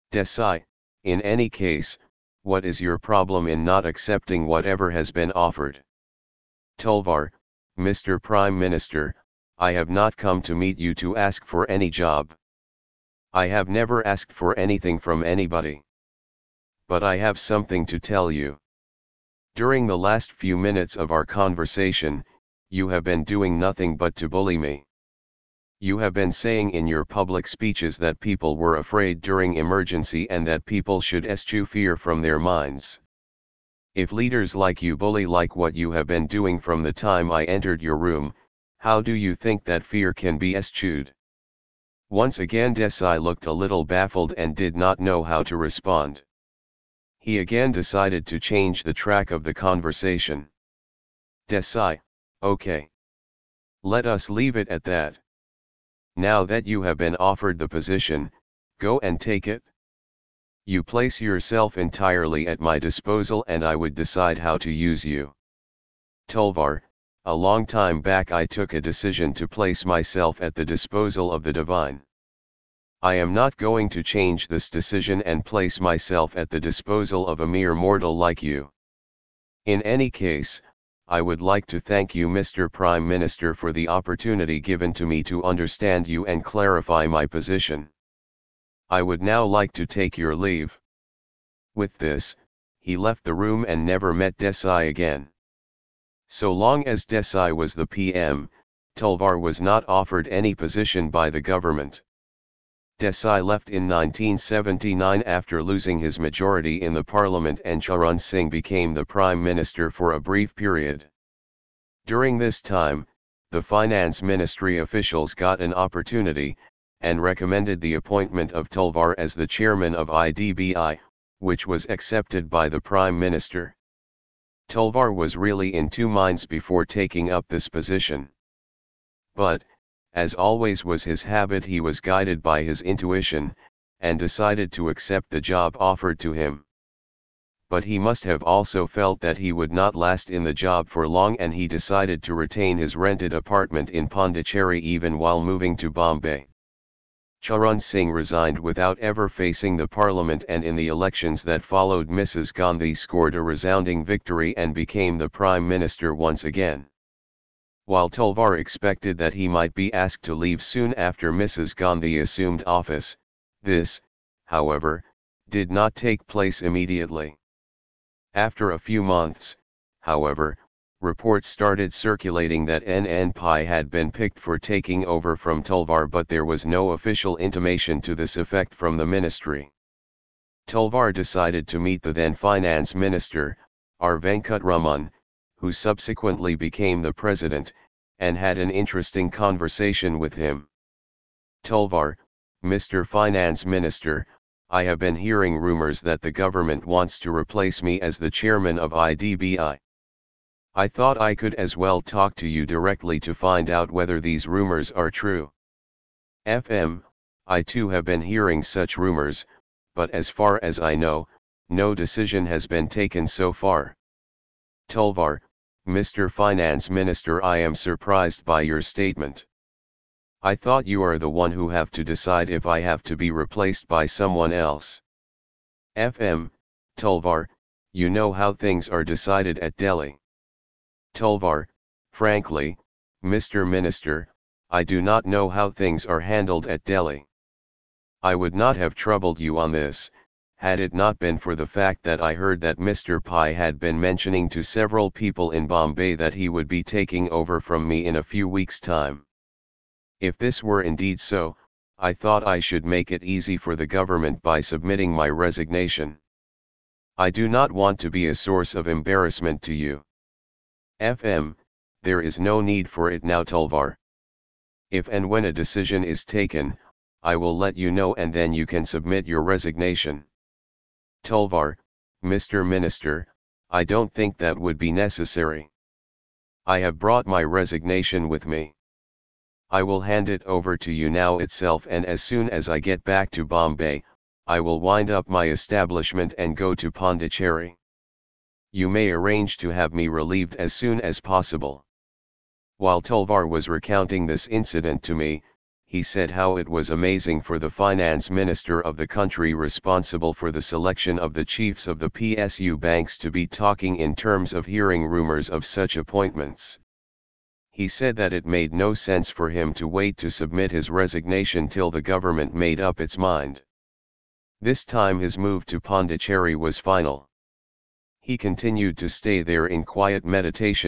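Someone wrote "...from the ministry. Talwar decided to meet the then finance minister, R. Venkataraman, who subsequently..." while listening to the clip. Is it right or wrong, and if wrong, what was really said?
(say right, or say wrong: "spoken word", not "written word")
right.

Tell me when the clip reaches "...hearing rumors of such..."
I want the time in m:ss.
5:04.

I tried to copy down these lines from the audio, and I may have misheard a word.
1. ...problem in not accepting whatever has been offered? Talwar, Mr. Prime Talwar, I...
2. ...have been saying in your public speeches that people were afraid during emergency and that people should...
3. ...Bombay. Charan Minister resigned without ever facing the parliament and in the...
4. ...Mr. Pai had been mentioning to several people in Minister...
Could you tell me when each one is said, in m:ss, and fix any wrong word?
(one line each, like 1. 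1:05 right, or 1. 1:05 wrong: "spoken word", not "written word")
1. 0:02 wrong: "Minister", not "Talwar"
2. 0:25 right
3. 2:25 wrong: "Singh", not "Minister"
4. 4:02 wrong: "Bombay", not "Minister".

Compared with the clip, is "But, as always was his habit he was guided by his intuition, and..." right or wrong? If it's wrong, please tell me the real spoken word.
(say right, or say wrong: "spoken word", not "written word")
right.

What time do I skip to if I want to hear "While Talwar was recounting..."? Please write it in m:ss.
4:52.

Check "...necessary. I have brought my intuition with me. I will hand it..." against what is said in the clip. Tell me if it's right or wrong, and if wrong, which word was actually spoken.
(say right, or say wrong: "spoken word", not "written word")
wrong: "resignation", not "intuition".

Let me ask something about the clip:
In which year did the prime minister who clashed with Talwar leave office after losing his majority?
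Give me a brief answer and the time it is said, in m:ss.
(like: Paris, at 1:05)
1979, at 1:43.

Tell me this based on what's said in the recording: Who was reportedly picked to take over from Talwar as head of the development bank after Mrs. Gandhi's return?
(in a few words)
NN Pai.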